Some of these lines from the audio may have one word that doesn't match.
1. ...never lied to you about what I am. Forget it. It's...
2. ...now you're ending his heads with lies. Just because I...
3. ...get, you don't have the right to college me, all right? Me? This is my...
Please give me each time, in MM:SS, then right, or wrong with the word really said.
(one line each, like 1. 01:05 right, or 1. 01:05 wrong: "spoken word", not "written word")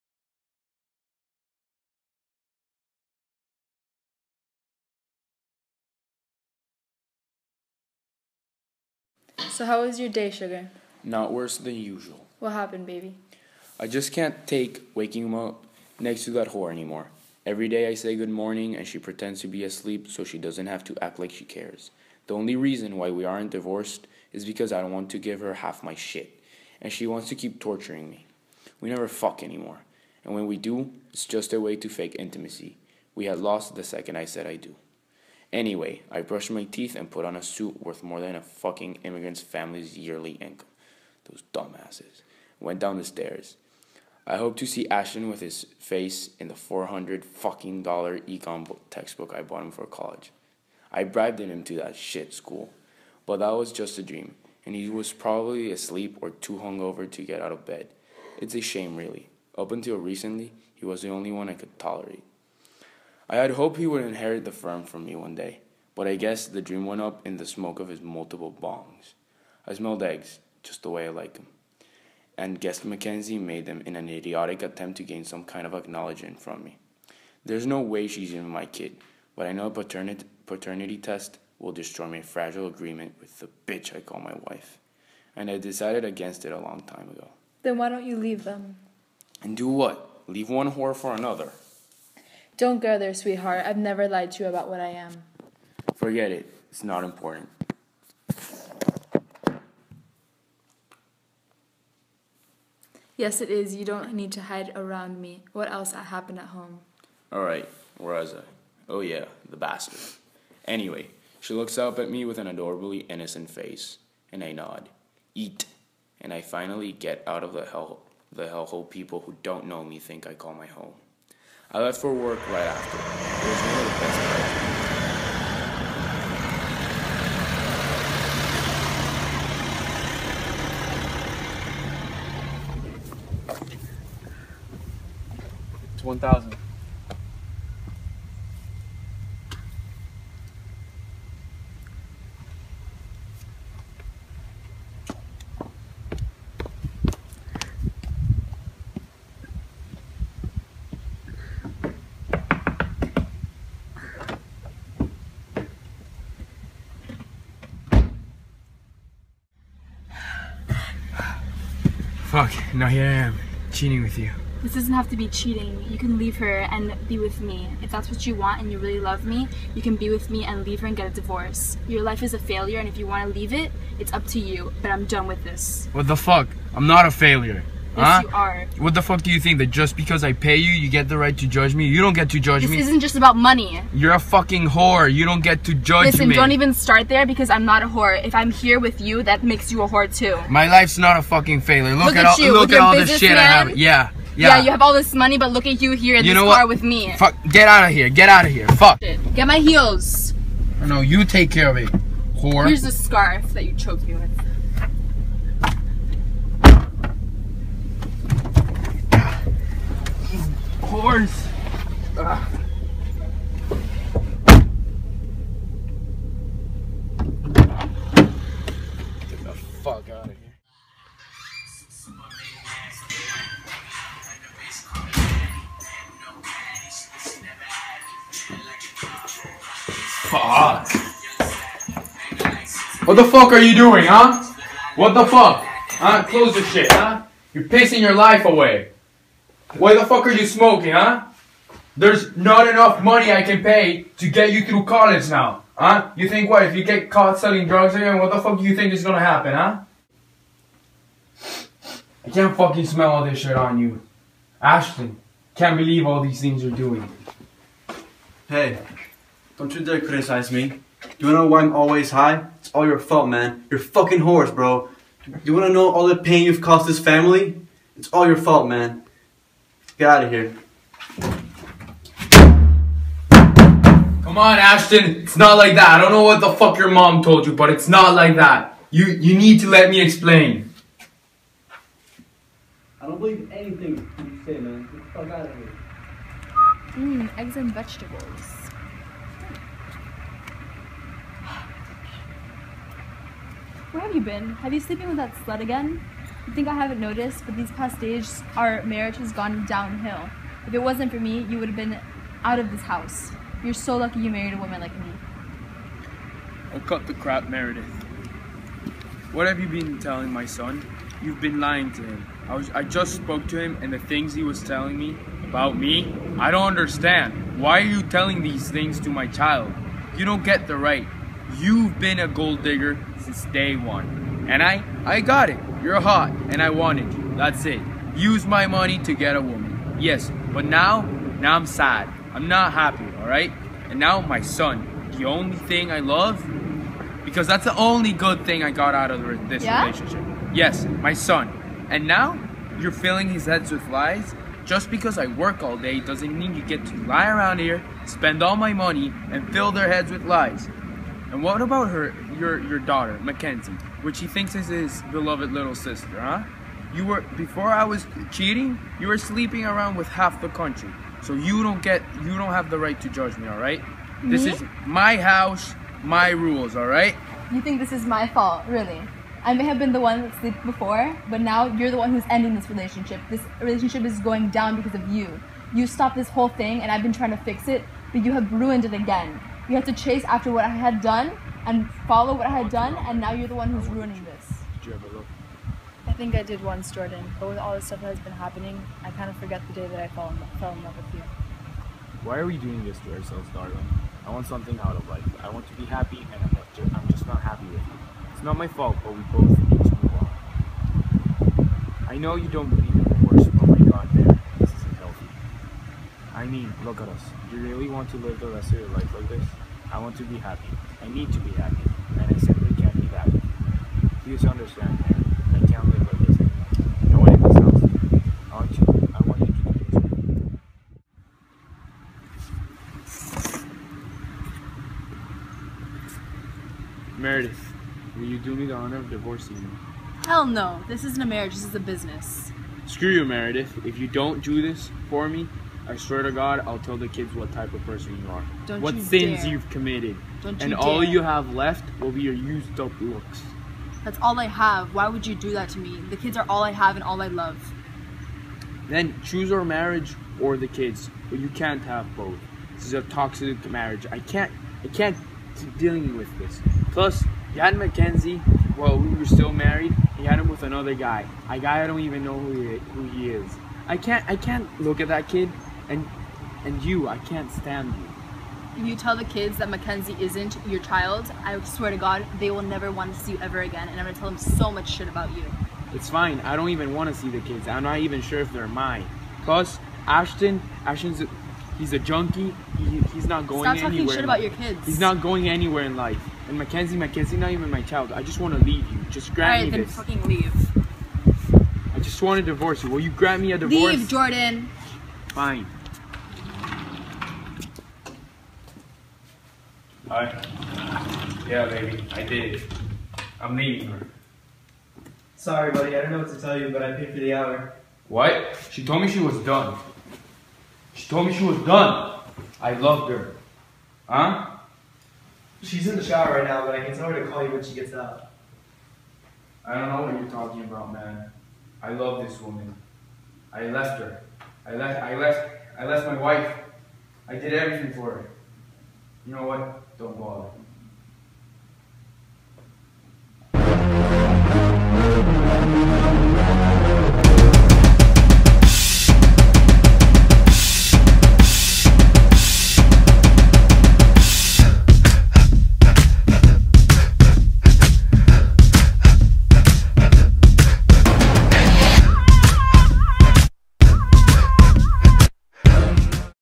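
1. 01:33 right
2. 05:42 wrong: "filling", not "ending"
3. 06:01 wrong: "judge", not "college".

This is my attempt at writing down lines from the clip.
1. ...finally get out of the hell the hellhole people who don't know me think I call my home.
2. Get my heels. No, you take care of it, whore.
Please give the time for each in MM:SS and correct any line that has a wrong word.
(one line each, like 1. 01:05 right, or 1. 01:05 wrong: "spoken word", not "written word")
1. 01:56 right
2. 03:19 right.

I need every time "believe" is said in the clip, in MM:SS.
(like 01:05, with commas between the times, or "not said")
04:15, 04:43, 06:42.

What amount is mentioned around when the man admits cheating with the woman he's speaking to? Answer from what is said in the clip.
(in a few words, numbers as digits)
1,000.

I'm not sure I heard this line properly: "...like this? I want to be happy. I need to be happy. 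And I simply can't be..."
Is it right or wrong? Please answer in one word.
right.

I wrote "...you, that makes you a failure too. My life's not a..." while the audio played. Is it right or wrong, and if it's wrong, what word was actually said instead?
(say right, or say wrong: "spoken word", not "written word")
wrong: "whore", not "failure".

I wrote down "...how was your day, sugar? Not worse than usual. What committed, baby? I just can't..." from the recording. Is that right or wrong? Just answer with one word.
wrong.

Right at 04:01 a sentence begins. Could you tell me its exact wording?
There's not enough money I can pay to get you through college now, huh?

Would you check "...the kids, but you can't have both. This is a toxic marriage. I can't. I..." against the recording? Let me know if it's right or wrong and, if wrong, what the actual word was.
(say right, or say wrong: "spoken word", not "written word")
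right.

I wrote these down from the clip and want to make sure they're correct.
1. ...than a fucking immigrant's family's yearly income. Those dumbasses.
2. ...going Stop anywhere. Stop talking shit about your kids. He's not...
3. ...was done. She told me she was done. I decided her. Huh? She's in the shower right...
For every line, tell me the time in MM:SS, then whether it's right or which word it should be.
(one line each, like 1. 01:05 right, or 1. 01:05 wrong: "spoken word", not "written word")
1. 00:38 right
2. 08:03 right
3. 08:29 wrong: "loved", not "decided".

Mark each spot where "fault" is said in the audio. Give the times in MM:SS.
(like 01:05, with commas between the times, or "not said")
04:22, 04:28, 06:08, 06:38.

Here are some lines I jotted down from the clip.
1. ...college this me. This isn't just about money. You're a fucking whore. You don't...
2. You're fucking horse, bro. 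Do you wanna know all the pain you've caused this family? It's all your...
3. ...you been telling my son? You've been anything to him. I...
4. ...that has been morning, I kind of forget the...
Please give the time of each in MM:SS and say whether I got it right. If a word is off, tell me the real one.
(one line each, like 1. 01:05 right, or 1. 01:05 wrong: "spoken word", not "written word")
1. 03:02 wrong: "judge", not "college"
2. 04:23 right
3. 05:09 wrong: "lying", not "anything"
4. 06:28 wrong: "happening", not "morning".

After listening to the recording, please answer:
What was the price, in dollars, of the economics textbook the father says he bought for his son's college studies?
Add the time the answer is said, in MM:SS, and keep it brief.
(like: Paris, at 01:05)
400, at 00:46.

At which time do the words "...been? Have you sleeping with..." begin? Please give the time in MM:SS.
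04:54.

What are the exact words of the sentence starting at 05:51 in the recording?
And what about her, your, your daughter, Mackenzie, which he thinks is his beloved little sister, huh?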